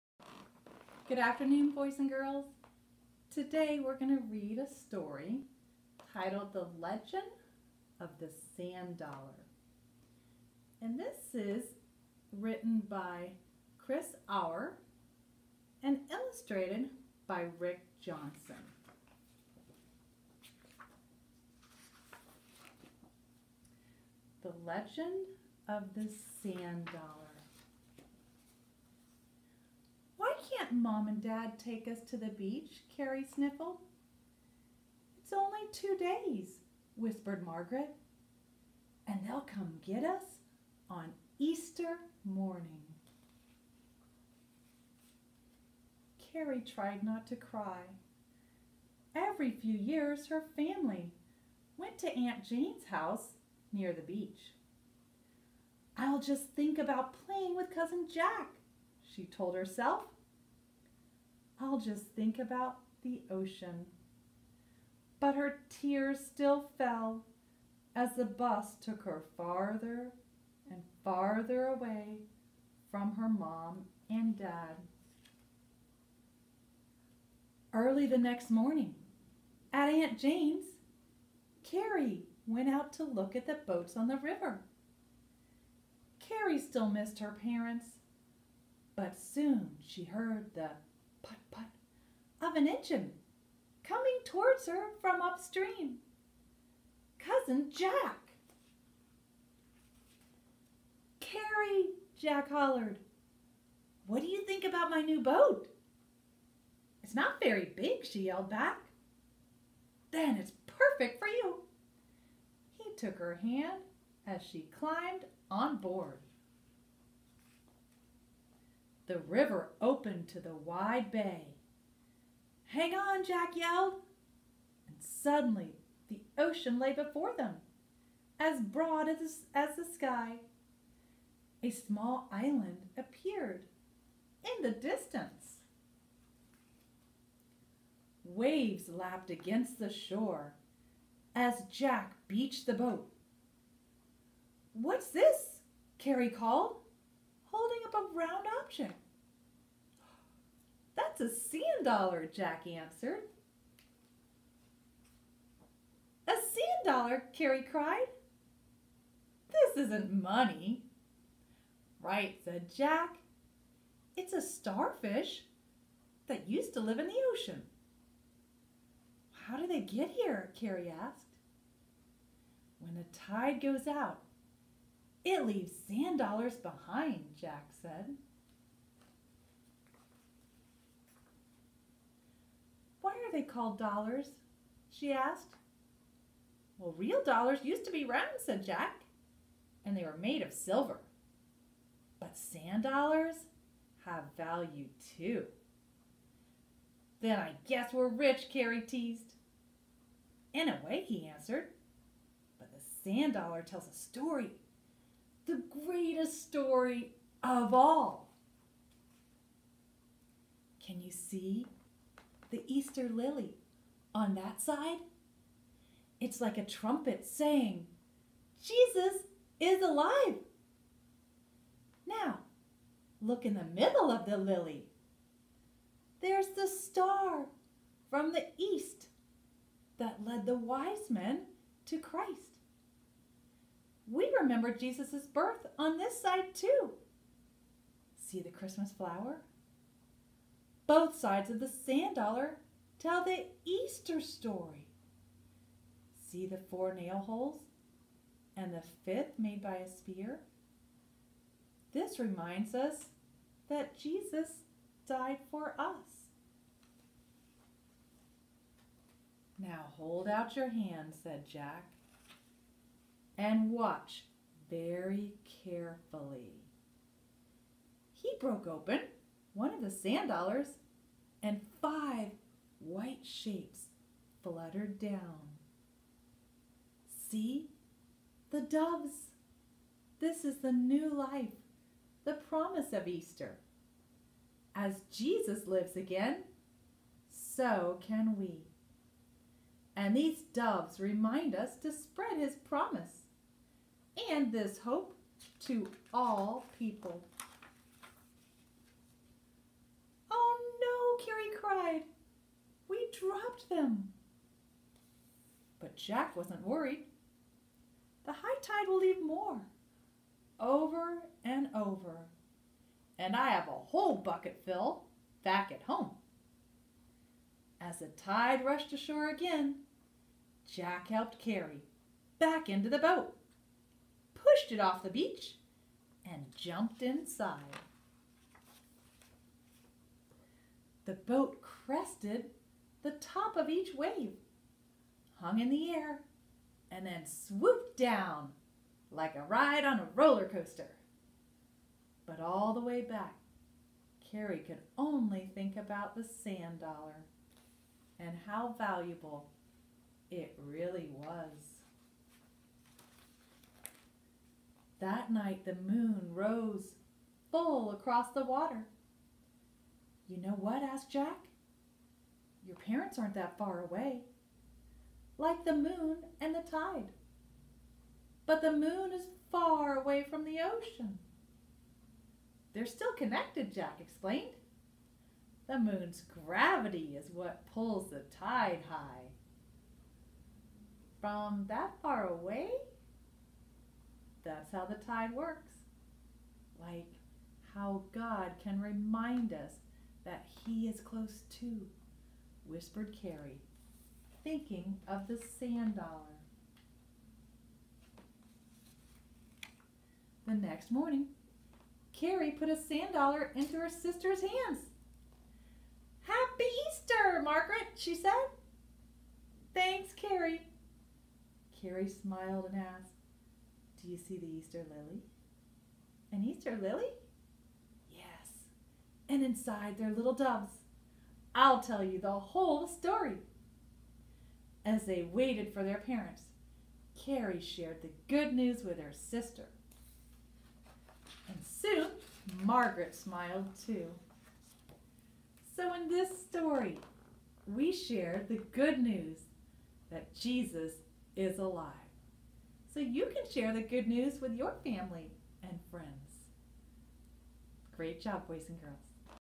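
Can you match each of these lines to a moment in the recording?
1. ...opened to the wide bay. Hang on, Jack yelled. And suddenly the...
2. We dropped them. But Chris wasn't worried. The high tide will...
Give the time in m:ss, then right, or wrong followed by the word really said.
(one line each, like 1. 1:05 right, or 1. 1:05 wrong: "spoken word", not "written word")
1. 1:59 right
2. 5:02 wrong: "Jack", not "Chris".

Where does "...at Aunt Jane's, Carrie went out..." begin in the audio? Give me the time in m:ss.
1:19.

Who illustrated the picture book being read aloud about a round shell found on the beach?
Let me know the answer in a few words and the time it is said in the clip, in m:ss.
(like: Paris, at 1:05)
Rick Johnson, at 0:17.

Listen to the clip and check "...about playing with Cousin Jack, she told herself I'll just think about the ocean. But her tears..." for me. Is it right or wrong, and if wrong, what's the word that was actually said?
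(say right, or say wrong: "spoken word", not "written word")
right.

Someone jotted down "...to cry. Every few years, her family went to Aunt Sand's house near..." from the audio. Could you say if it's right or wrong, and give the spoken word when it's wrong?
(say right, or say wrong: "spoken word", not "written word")
wrong: "Jane", not "Sand".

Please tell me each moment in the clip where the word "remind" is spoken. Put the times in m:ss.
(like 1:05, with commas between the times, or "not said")
4:12, 4:50, 6:28.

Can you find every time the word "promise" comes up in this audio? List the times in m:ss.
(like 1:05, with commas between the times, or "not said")
4:42, 4:52.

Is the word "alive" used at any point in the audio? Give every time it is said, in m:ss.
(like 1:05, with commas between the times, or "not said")
3:39, 7:21.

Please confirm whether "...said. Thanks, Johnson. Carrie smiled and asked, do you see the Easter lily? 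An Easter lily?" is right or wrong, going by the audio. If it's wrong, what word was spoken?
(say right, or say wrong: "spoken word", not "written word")
wrong: "Carrie", not "Johnson".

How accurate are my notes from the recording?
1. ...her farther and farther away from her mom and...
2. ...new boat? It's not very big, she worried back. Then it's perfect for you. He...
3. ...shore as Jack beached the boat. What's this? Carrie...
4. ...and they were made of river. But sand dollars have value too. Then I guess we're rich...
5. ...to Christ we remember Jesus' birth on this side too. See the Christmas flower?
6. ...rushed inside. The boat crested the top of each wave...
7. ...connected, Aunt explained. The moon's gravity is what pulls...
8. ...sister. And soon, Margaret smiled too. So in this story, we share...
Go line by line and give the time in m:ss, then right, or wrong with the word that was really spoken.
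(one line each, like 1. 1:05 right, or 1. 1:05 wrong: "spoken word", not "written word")
1. 1:09 right
2. 1:45 wrong: "yelled", not "worried"
3. 2:19 right
4. 3:09 wrong: "silver", not "river"
5. 3:51 right
6. 5:26 wrong: "jumped", not "rushed"
7. 6:13 wrong: "Jack", not "Aunt"
8. 7:09 right.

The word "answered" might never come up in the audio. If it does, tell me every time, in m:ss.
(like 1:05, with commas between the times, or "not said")
2:32, 3:21.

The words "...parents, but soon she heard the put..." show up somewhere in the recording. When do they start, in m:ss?
1:27.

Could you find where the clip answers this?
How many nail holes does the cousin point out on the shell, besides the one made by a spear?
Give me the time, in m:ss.
4:06.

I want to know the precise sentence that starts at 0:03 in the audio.
Today we're going to read a story titled The Legend of the Sand Dollar.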